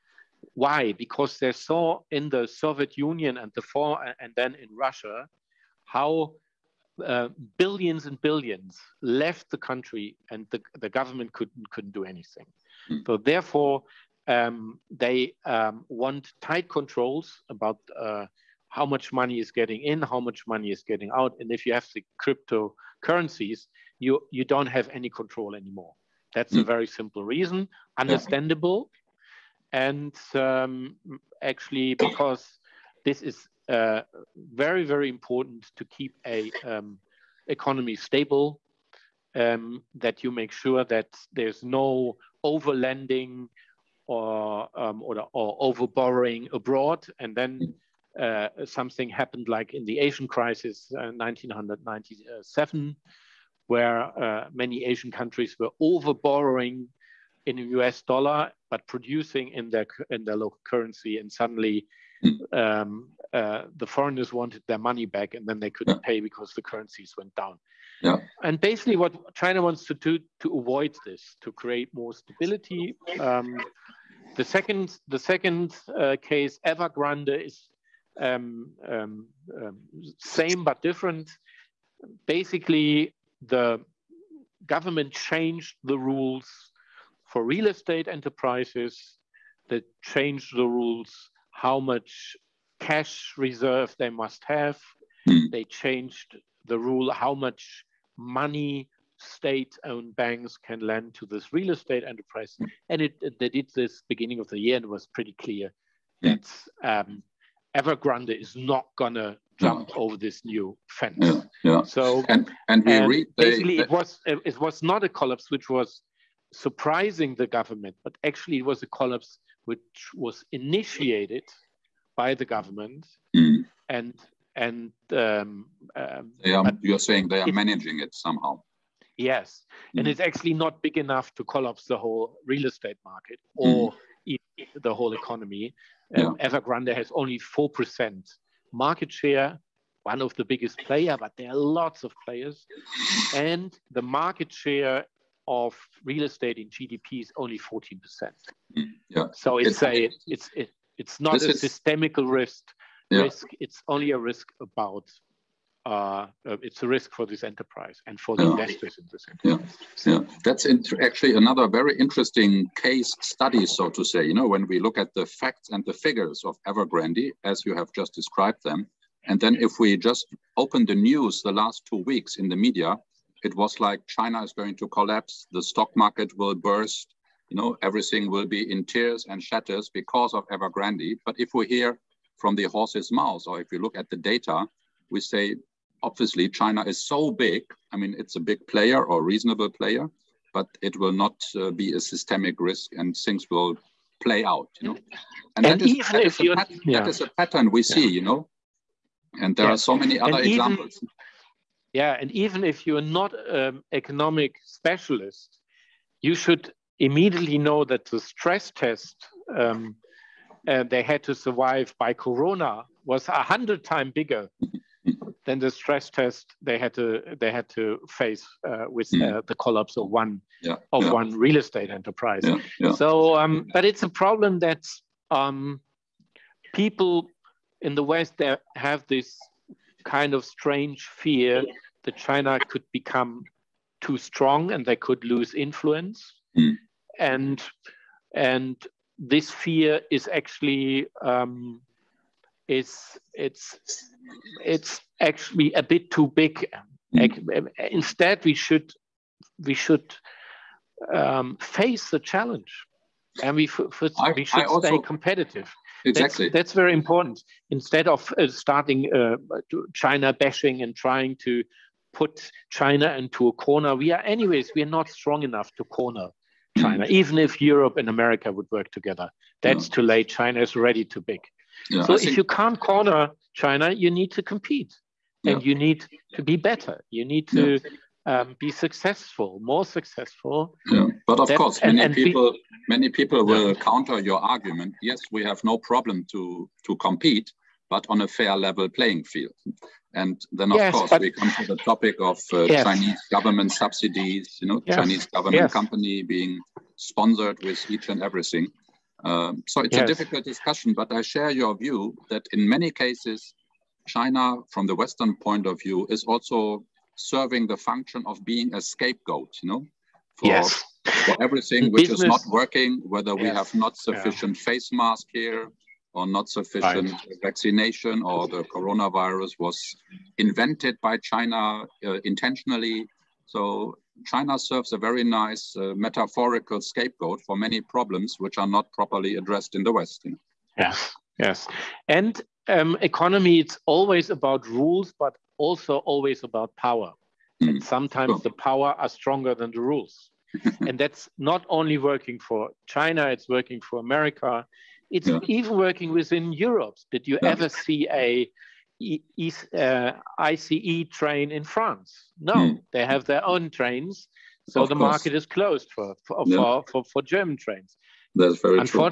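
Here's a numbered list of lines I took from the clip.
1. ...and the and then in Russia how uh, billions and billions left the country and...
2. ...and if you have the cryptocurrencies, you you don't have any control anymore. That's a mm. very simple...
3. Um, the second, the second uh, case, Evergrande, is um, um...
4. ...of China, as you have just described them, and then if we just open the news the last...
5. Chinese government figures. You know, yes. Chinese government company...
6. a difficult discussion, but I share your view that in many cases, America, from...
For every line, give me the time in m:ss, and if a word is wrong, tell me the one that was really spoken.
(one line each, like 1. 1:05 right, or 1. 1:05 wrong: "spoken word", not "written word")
1. 0:03 right
2. 0:21 right
3. 1:13 right
4. 2:46 wrong: "Evergrande", not "China"
5. 4:52 wrong: "subsidies", not "figures"
6. 5:00 wrong: "China", not "America".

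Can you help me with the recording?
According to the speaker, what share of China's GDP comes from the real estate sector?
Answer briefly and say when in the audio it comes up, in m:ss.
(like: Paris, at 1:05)
14%, at 2:27.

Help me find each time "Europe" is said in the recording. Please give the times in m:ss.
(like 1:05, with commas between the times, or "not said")
4:27, 5:46.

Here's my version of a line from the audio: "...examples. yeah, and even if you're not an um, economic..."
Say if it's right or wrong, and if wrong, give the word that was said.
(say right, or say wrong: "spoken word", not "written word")
right.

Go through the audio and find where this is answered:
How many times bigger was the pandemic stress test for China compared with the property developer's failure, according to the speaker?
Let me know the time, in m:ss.
3:33.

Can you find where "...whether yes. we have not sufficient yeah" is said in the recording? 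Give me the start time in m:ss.
5:13.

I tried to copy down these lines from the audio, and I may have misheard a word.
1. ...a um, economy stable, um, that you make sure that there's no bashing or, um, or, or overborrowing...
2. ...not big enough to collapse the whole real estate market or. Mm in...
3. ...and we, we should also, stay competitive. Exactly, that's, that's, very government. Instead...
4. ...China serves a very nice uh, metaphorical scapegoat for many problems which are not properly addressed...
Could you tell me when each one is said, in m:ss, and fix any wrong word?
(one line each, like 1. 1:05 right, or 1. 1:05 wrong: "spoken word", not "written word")
1. 0:36 wrong: "overlending", not "bashing"
2. 2:10 right
3. 4:13 wrong: "important", not "government"
4. 5:24 right.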